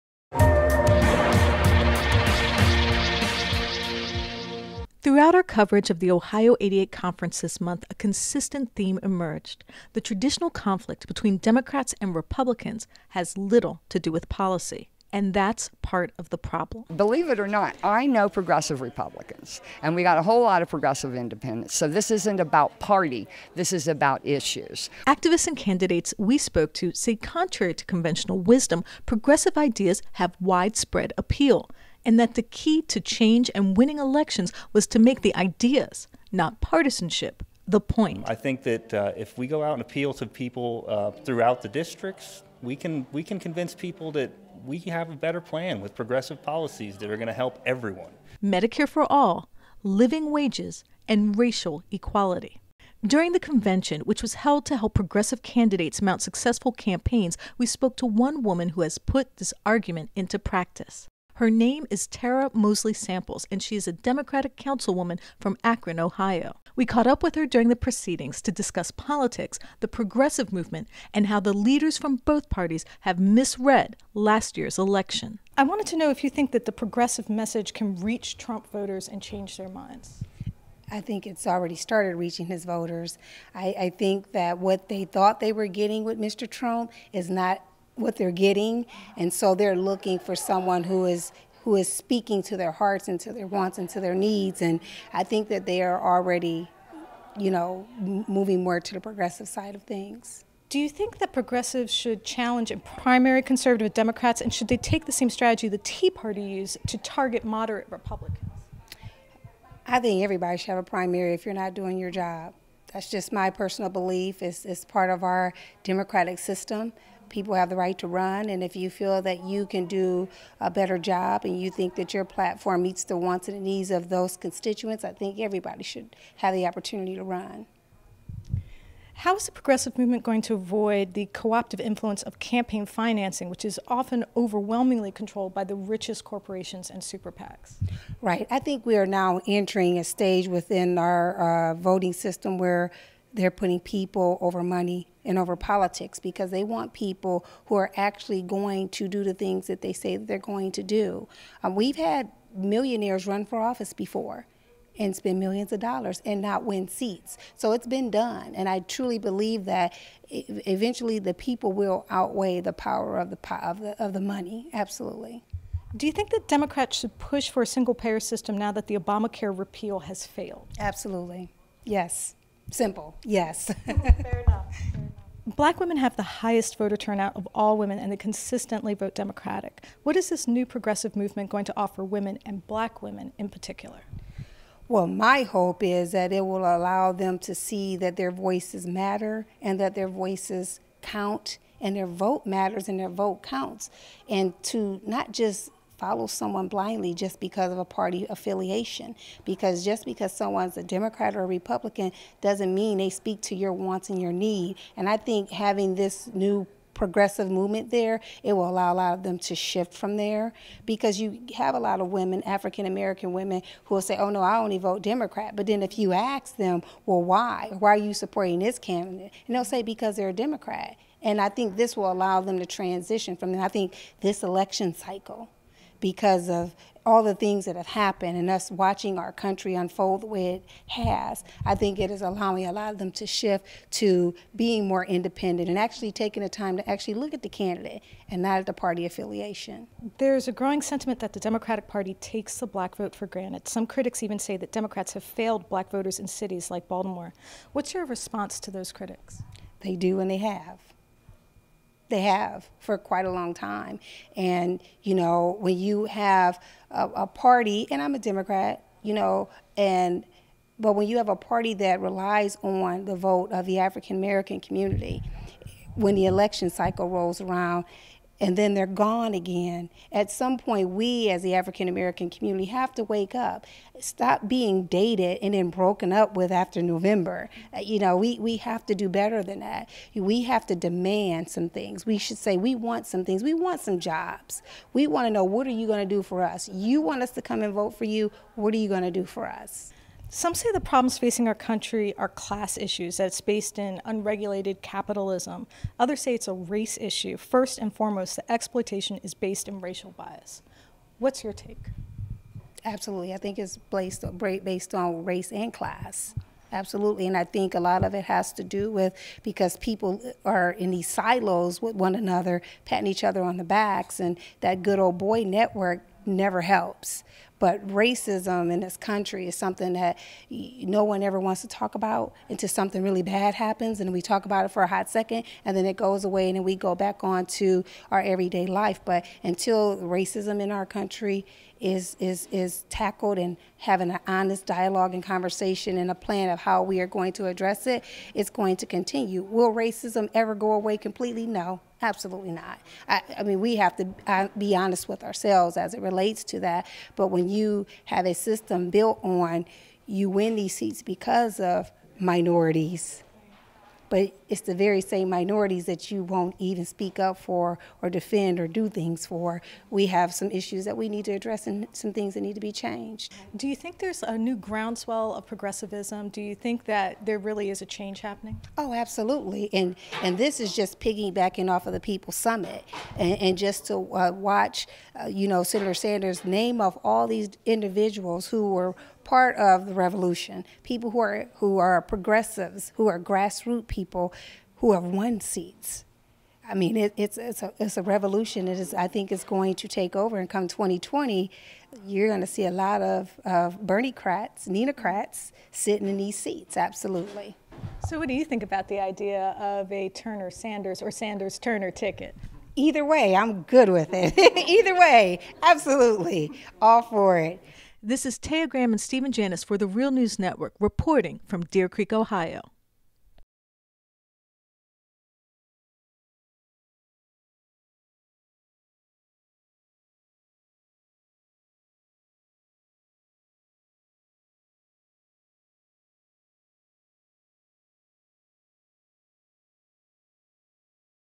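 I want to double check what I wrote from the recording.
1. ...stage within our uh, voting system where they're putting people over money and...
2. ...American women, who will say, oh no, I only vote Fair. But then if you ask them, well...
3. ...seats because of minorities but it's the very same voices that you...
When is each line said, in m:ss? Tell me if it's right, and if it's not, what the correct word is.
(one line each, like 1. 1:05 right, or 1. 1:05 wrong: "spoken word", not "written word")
1. 2:20 right
2. 3:32 wrong: "Democrat", not "Fair"
3. 5:50 wrong: "minorities", not "voices".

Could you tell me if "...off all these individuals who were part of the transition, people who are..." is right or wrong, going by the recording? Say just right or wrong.
wrong.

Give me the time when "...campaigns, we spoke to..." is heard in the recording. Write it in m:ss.
0:56.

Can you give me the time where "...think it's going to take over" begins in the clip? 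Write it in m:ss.
6:29.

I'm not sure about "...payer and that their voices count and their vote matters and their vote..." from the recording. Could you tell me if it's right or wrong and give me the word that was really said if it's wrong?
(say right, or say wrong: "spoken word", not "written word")
wrong: "matter", not "payer".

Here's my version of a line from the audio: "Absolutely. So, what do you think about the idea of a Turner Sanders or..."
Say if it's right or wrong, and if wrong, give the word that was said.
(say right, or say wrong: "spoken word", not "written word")
right.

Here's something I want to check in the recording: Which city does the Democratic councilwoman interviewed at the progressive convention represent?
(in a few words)
Akron, Ohio.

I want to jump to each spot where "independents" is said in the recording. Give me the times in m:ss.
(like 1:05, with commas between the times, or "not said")
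0:21, 3:55.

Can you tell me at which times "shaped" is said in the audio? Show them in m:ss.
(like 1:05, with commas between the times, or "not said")
not said.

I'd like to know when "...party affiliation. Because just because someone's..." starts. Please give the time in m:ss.
3:17.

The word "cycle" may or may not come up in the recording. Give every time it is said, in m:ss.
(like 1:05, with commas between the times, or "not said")
3:44, 4:26.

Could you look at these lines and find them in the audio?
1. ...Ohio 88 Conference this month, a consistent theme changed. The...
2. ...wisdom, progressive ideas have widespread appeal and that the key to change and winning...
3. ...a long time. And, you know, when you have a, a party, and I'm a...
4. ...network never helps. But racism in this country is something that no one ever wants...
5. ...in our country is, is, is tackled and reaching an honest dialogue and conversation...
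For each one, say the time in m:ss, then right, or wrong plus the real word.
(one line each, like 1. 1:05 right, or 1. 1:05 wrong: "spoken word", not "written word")
1. 0:06 wrong: "emerged", not "changed"
2. 0:28 right
3. 4:13 right
4. 5:15 right
5. 5:30 wrong: "having", not "reaching".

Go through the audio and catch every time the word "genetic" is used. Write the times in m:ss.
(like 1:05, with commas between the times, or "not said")
not said.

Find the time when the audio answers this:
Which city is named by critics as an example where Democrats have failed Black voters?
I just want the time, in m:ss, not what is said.
4:06.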